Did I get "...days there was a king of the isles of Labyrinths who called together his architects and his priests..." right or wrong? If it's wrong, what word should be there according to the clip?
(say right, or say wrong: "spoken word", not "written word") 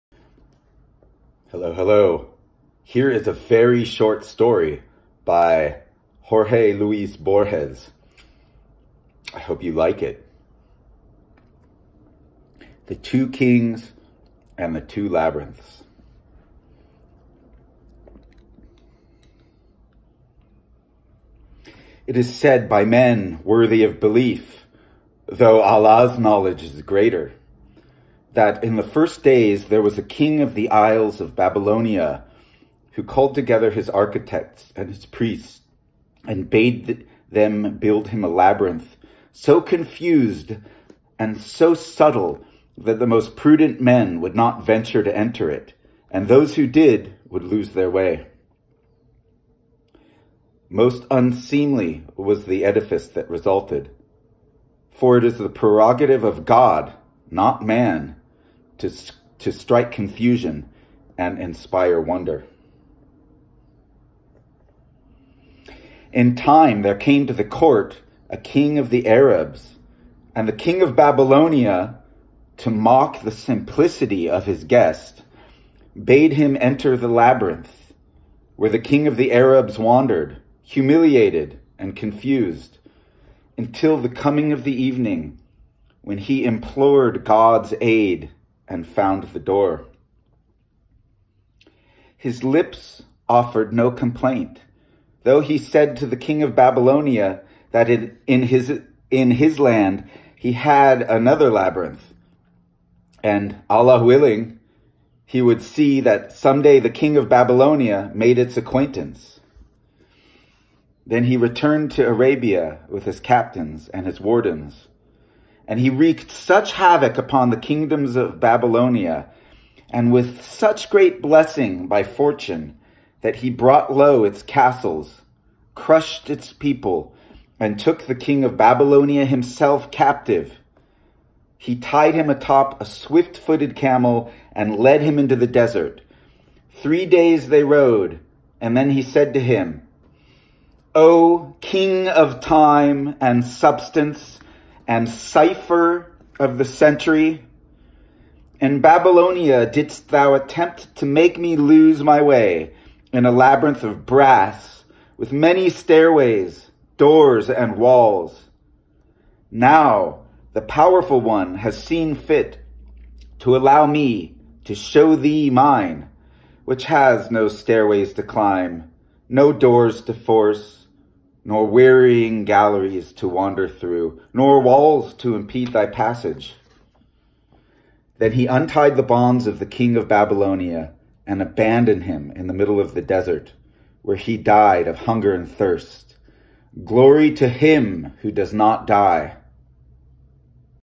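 wrong: "Babylonia", not "Labyrinths".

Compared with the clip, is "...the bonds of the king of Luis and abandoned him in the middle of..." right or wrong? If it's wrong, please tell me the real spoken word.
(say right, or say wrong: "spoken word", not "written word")
wrong: "Babylonia", not "Luis".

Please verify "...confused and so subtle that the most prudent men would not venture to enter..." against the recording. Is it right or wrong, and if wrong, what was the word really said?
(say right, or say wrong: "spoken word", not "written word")
right.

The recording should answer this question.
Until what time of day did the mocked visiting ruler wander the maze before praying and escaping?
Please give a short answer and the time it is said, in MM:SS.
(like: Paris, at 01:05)
Evening, at 01:24.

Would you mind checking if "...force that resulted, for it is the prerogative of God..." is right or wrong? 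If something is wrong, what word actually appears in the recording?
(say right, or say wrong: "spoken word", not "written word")
wrong: "edifice", not "force".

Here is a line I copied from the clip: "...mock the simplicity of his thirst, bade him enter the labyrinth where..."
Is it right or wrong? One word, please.
wrong.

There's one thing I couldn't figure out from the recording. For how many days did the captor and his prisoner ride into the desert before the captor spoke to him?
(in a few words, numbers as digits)
3.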